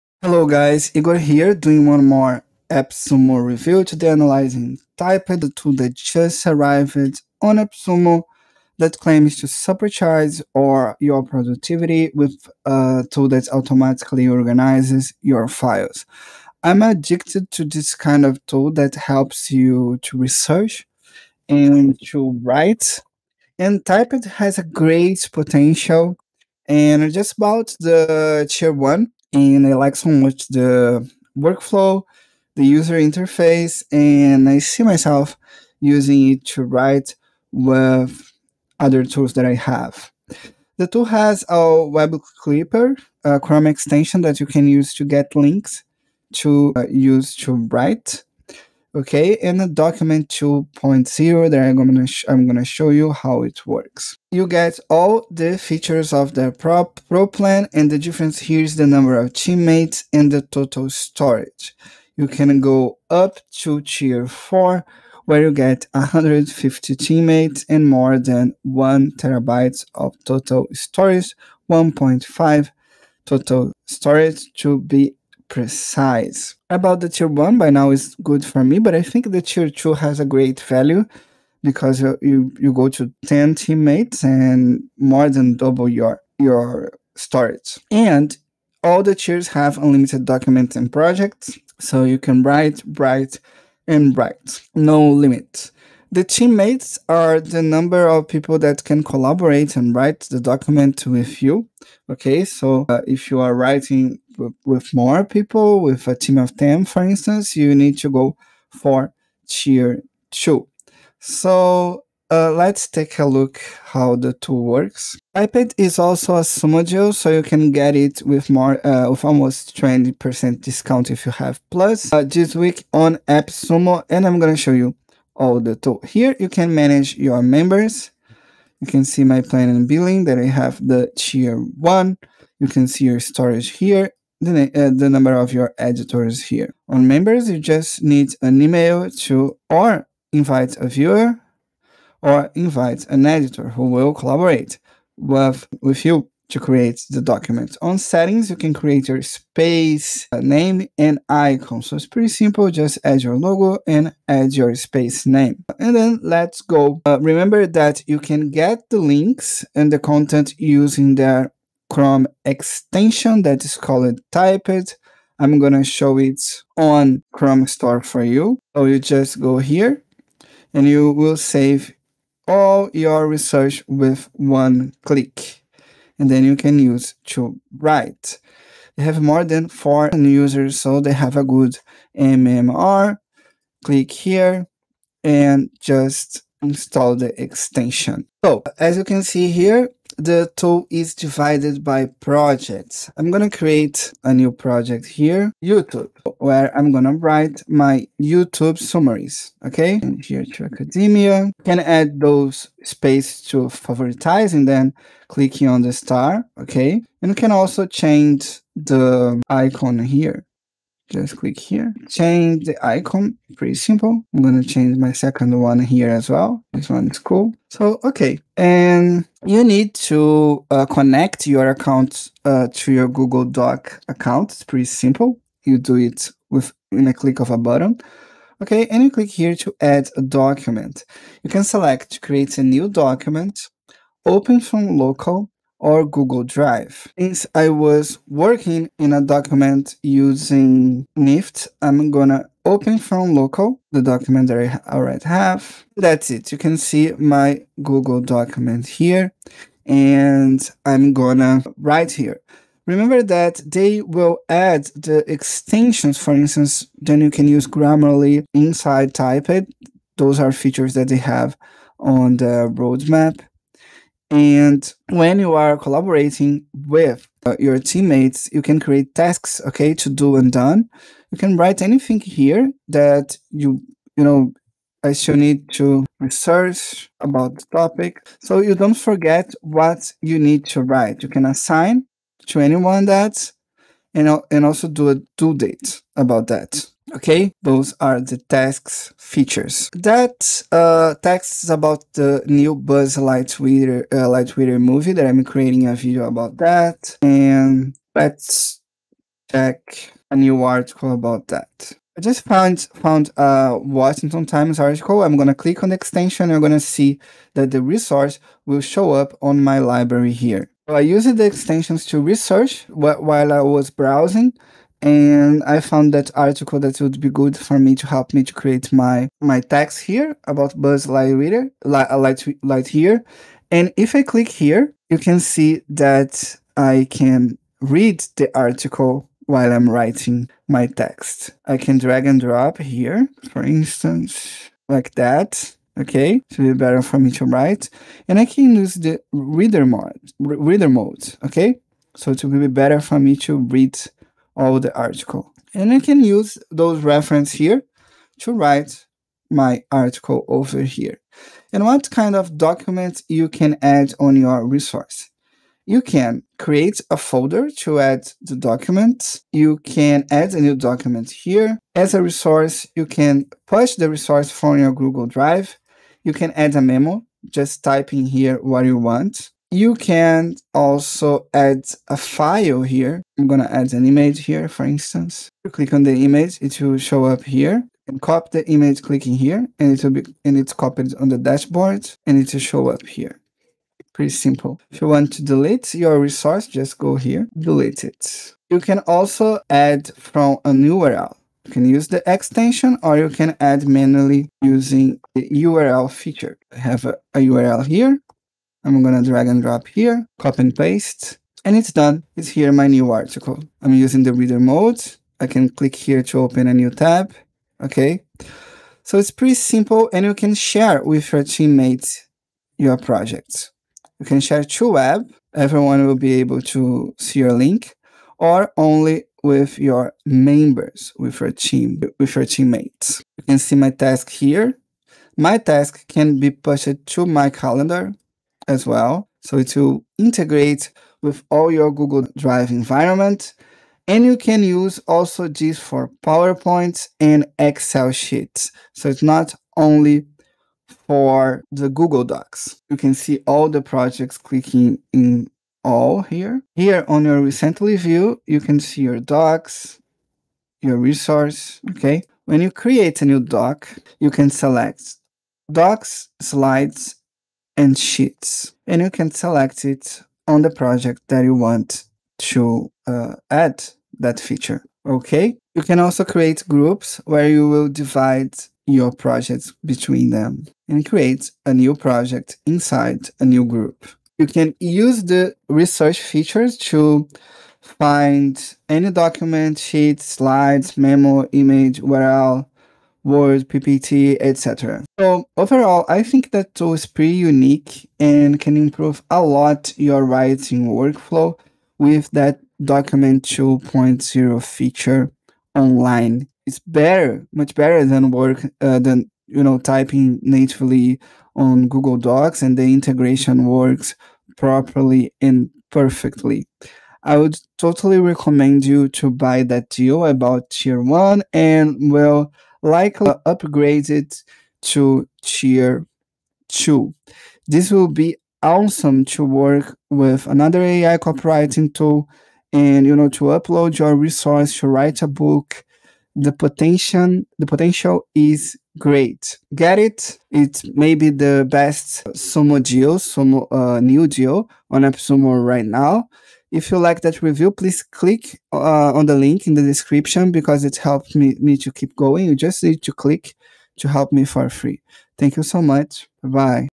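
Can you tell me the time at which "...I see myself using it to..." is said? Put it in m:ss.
0:34.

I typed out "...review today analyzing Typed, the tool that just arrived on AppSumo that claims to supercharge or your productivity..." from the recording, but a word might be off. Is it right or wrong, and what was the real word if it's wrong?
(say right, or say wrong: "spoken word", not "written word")
right.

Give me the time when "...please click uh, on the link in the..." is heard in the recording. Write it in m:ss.
8:57.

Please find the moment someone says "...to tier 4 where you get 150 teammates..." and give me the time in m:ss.
1:03.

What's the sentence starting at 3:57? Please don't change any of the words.
Since I was working in a document using NIFT, I'm gonna open from local the document that I already have.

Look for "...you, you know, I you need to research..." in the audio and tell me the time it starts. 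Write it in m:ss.
4:33.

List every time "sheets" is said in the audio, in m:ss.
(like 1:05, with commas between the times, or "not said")
7:18, 7:37, 7:59.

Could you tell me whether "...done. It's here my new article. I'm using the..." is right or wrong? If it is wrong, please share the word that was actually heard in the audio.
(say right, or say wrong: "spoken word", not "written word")
right.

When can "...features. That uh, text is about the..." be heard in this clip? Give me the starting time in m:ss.
4:49.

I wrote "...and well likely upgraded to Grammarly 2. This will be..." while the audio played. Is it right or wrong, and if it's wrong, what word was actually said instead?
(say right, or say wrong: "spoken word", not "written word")
wrong: "Tier", not "Grammarly".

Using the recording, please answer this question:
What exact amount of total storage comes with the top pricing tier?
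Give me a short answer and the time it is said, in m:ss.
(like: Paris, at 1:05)
1.5 terabytes, at 1:11.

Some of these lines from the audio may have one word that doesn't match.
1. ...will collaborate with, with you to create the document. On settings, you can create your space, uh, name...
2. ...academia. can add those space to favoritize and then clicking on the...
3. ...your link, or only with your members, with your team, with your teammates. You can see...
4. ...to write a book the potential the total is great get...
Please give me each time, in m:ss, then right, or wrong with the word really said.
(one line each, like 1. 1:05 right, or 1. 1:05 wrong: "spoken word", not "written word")
1. 2:23 right
2. 3:20 right
3. 6:57 right
4. 8:44 wrong: "potential", not "total".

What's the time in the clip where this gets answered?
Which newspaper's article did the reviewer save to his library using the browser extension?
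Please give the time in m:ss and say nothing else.
5:03.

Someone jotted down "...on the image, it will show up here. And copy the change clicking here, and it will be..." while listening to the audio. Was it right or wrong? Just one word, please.
wrong.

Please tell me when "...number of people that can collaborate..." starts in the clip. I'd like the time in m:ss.
1:37.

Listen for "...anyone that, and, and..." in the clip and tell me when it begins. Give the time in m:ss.
4:42.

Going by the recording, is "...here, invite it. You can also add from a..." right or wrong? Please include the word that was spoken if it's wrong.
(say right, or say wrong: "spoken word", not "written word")
wrong: "delete", not "invite".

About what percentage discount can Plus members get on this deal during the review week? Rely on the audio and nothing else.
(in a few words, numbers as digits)
20%.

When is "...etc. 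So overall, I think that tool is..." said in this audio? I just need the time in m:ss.
8:04.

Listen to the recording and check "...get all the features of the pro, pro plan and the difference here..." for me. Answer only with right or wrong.
right.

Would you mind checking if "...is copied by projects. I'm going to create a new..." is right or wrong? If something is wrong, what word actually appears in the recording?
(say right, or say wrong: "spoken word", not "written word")
wrong: "divided", not "copied".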